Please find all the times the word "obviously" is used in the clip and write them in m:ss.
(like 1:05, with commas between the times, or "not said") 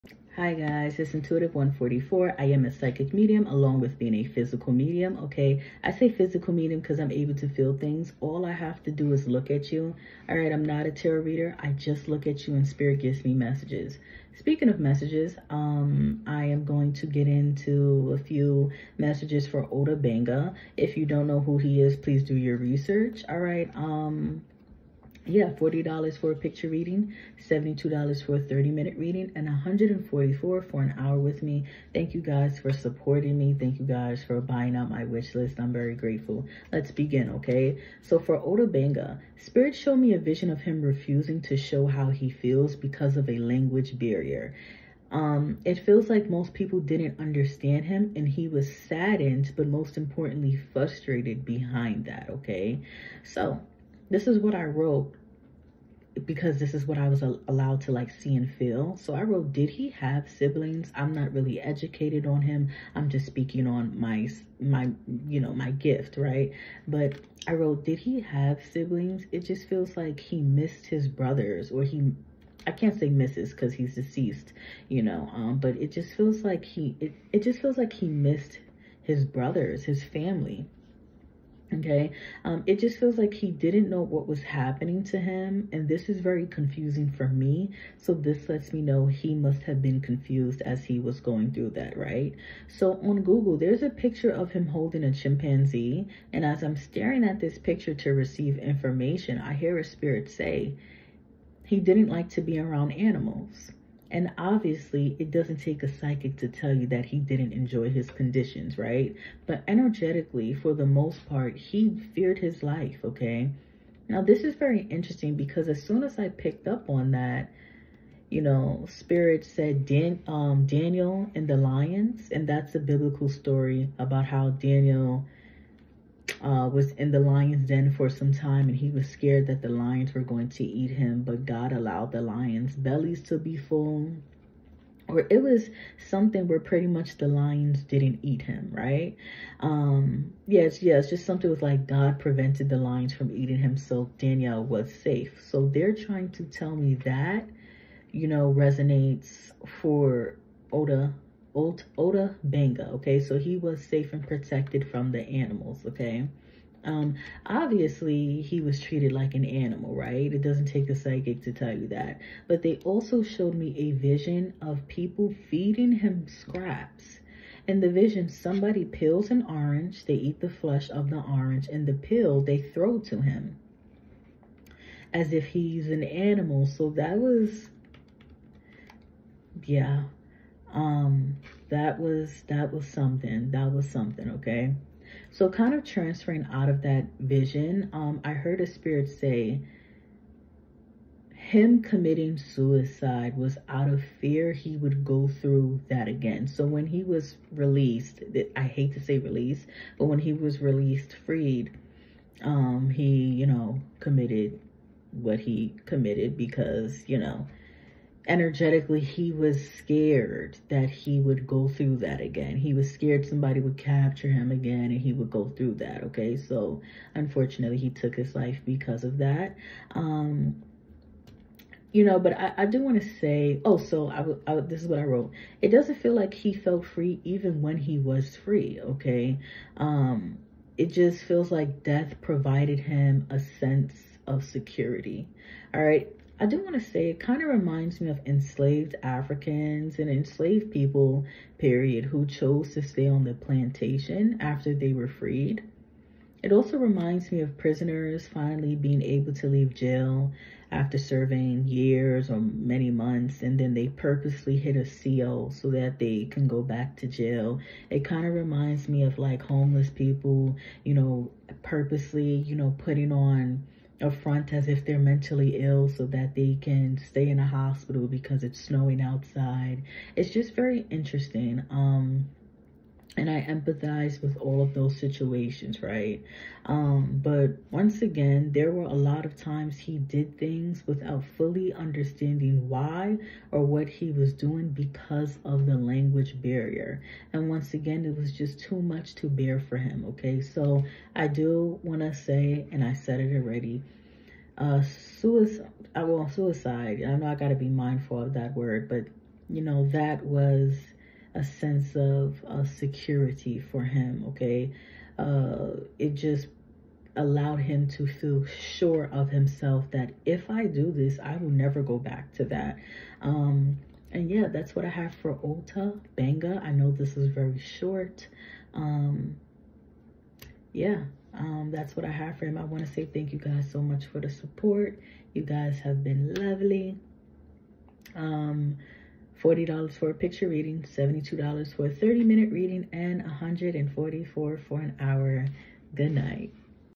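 1:44, 2:37.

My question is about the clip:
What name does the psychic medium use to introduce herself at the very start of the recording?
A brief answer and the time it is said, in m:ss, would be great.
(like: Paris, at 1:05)
Intuitive144, at 0:01.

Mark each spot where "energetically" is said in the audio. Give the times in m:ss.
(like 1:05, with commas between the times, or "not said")
1:49, 3:28.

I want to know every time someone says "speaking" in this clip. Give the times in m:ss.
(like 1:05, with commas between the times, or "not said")
0:14, 1:03.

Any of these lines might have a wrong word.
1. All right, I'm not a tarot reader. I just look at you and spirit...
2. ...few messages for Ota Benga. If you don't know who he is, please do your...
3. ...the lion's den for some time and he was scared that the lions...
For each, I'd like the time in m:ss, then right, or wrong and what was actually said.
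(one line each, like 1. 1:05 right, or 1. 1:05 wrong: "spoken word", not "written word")
1. 0:10 right
2. 0:18 right
3. 2:07 right.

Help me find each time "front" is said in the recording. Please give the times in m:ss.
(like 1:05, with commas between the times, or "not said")
4:24.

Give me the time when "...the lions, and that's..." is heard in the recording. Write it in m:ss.
2:01.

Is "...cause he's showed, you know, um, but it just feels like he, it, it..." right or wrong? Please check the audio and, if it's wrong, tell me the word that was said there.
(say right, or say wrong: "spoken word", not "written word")
wrong: "deceased", not "showed".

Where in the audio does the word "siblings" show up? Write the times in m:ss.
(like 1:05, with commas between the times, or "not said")
1:00, 1:08.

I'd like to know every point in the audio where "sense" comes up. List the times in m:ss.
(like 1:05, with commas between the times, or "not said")
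3:53, 5:01.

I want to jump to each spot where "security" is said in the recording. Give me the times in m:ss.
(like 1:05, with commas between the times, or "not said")
3:54, 5:02.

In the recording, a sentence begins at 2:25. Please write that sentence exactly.
So they're trying to tell me that, you know, resonates for Ota Ot- Ota Benga.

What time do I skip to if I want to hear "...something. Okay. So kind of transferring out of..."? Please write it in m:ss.
3:03.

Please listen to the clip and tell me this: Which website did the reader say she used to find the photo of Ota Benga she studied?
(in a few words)
Google.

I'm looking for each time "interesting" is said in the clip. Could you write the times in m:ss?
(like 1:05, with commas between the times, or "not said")
1:54, 4:30.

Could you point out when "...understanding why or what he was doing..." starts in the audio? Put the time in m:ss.
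4:41.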